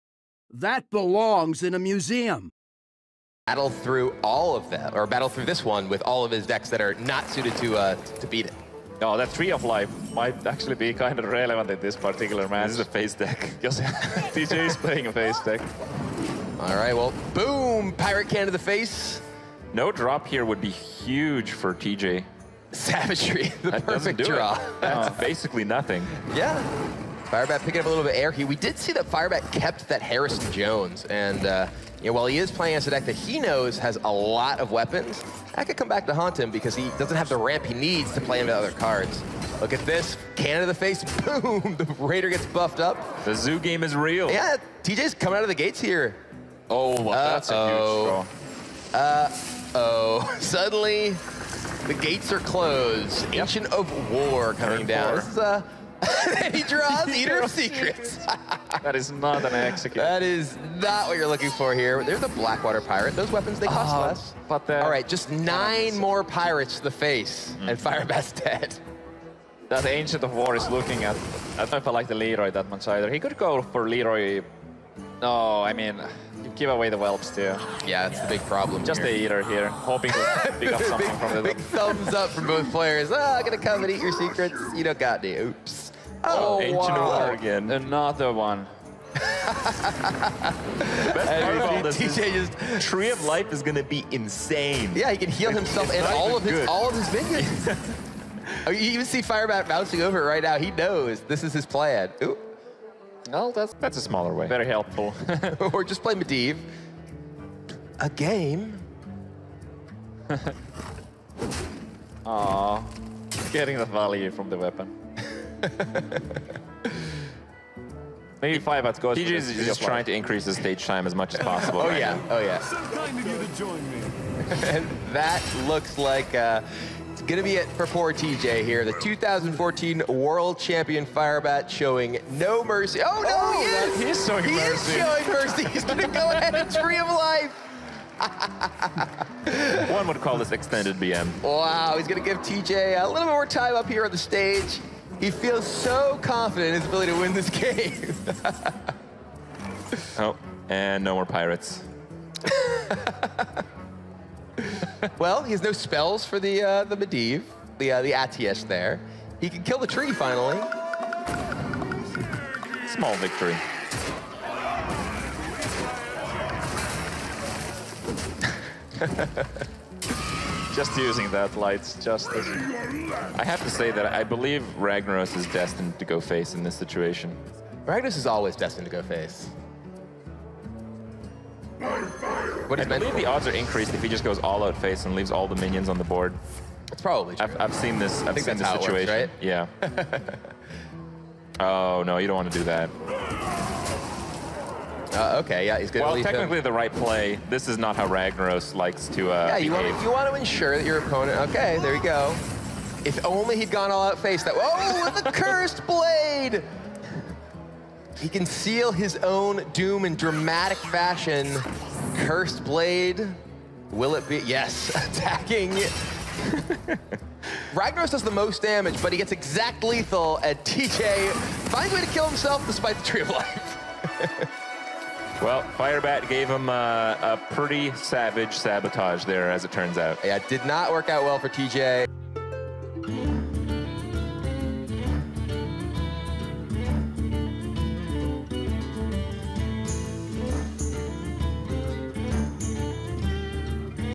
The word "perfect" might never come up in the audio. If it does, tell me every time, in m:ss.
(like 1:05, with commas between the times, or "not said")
0:23.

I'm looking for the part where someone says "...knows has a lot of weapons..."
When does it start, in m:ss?
0:33.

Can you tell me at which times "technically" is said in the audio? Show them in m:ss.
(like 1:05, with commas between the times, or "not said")
3:16.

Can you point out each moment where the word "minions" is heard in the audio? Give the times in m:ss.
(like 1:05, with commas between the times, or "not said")
1:37, 3:05.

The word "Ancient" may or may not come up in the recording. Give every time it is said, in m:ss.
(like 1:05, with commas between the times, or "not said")
0:53, 1:09, 1:26.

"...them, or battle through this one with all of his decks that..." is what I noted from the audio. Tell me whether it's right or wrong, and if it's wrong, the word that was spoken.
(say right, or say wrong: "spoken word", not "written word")
right.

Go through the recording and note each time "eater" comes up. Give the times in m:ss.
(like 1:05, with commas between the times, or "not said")
0:57, 1:19.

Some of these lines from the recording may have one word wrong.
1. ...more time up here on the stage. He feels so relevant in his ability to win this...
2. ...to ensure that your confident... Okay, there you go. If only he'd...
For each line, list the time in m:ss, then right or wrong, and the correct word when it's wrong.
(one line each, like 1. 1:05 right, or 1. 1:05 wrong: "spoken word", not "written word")
1. 2:23 wrong: "confident", not "relevant"
2. 3:20 wrong: "opponent", not "confident".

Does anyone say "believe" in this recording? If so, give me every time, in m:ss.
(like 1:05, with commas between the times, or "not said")
2:54, 3:02.